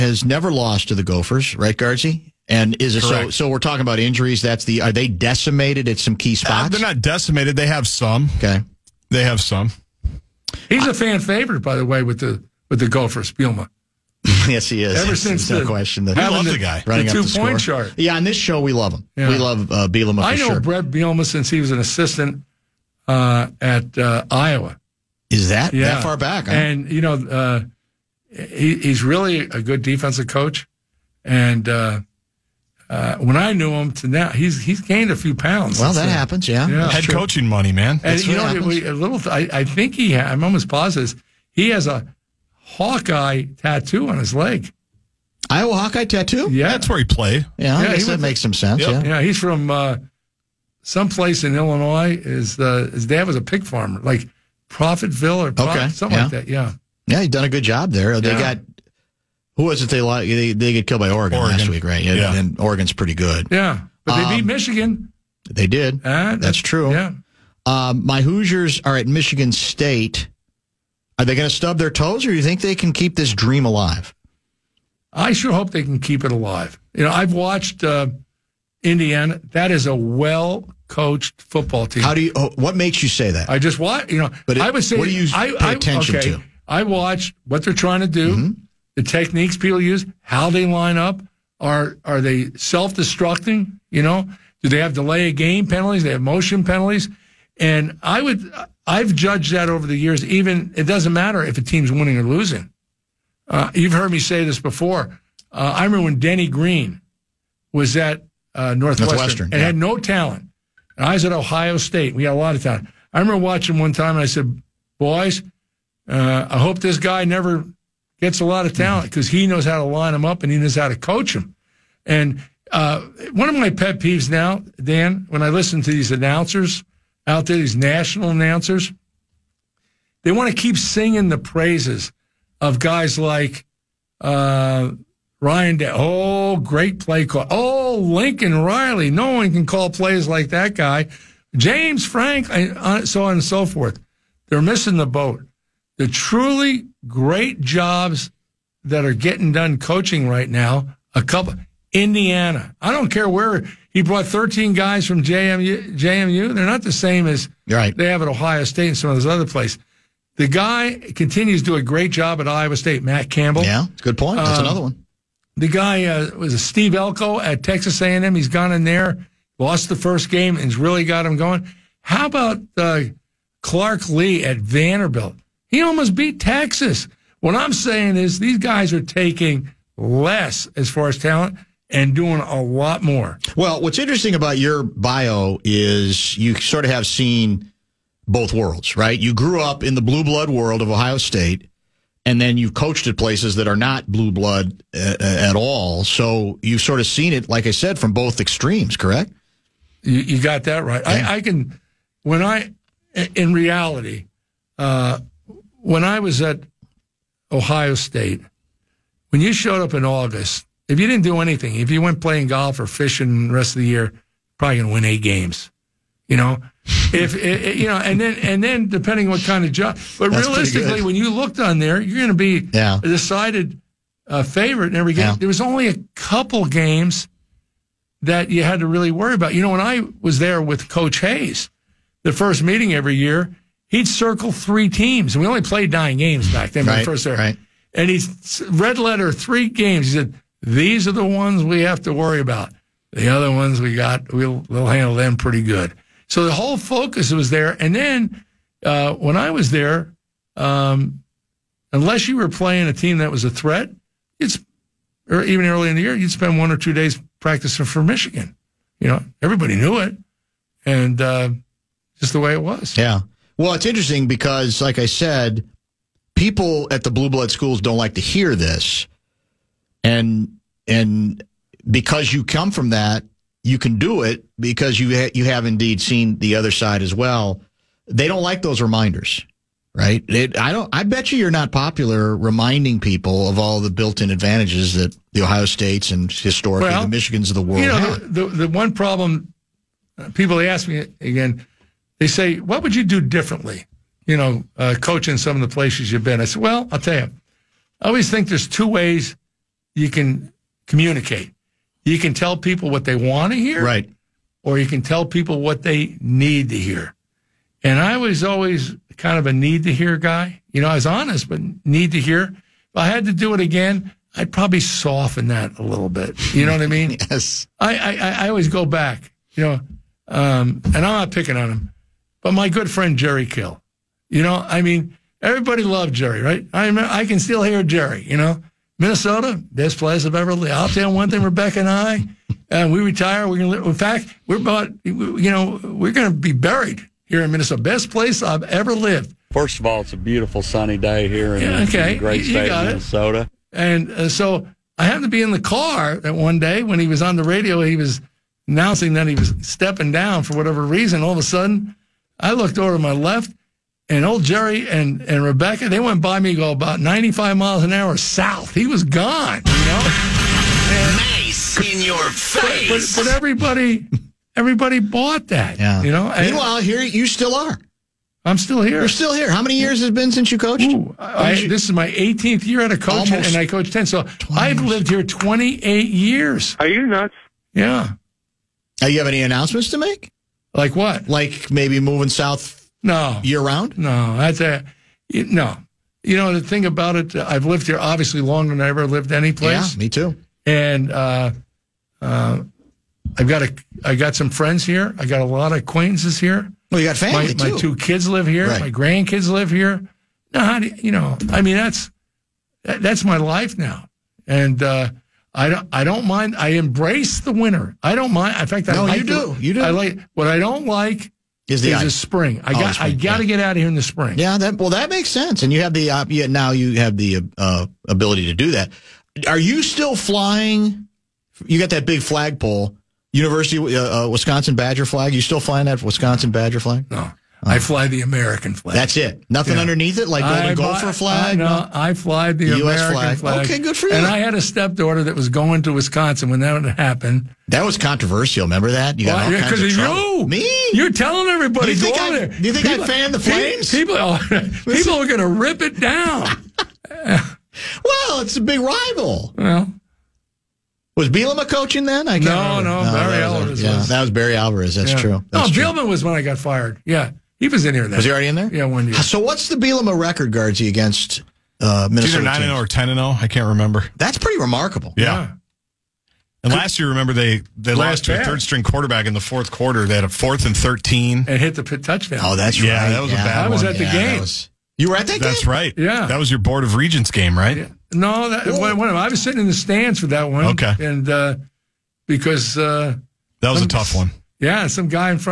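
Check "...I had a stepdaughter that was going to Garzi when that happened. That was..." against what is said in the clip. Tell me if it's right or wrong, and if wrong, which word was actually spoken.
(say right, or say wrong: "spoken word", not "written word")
wrong: "Wisconsin", not "Garzi".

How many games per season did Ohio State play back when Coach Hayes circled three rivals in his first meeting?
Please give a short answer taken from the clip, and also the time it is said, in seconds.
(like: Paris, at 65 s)
9, at 235 s.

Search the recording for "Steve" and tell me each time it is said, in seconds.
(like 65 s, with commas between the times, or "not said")
166 s.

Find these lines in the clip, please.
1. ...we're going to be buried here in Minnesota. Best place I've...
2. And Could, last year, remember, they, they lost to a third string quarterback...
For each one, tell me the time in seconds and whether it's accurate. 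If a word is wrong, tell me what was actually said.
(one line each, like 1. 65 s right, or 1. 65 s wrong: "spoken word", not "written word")
1. 335 s right
2. 466 s right.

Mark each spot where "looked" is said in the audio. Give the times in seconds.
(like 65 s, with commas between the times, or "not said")
221 s, 352 s.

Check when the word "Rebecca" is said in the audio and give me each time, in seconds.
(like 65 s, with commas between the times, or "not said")
331 s, 355 s.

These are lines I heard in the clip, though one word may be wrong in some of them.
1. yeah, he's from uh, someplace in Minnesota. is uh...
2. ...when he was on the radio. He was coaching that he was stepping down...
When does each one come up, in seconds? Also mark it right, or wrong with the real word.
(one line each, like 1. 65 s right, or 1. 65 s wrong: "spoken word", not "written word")
1. 49 s wrong: "Illinois", not "Minnesota"
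2. 346 s wrong: "announcing", not "coaching".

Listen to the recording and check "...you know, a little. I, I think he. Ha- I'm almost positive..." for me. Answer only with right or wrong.
right.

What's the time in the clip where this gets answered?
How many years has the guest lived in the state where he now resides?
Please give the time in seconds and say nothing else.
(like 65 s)
375 s.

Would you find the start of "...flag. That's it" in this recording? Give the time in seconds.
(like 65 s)
428 s.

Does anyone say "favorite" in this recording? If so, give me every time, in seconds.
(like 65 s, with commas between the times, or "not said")
11 s, 224 s.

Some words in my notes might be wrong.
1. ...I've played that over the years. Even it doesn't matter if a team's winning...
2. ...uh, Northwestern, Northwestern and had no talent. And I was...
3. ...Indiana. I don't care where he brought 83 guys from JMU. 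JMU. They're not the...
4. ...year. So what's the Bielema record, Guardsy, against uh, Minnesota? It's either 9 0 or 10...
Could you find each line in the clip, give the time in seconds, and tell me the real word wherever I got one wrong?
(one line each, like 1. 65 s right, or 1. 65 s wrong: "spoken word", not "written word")
1. 98 s wrong: "judged", not "played"
2. 108 s right
3. 151 s wrong: "13", not "83"
4. 459 s right.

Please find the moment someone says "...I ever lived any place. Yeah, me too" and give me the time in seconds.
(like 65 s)
388 s.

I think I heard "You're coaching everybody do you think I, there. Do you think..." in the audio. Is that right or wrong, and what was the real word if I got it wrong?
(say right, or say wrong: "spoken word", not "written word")
wrong: "telling", not "coaching".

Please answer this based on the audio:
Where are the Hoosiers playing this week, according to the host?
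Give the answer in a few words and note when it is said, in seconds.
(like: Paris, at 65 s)
Michigan State, at 69 s.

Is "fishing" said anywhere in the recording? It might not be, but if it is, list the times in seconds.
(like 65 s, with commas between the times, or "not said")
212 s.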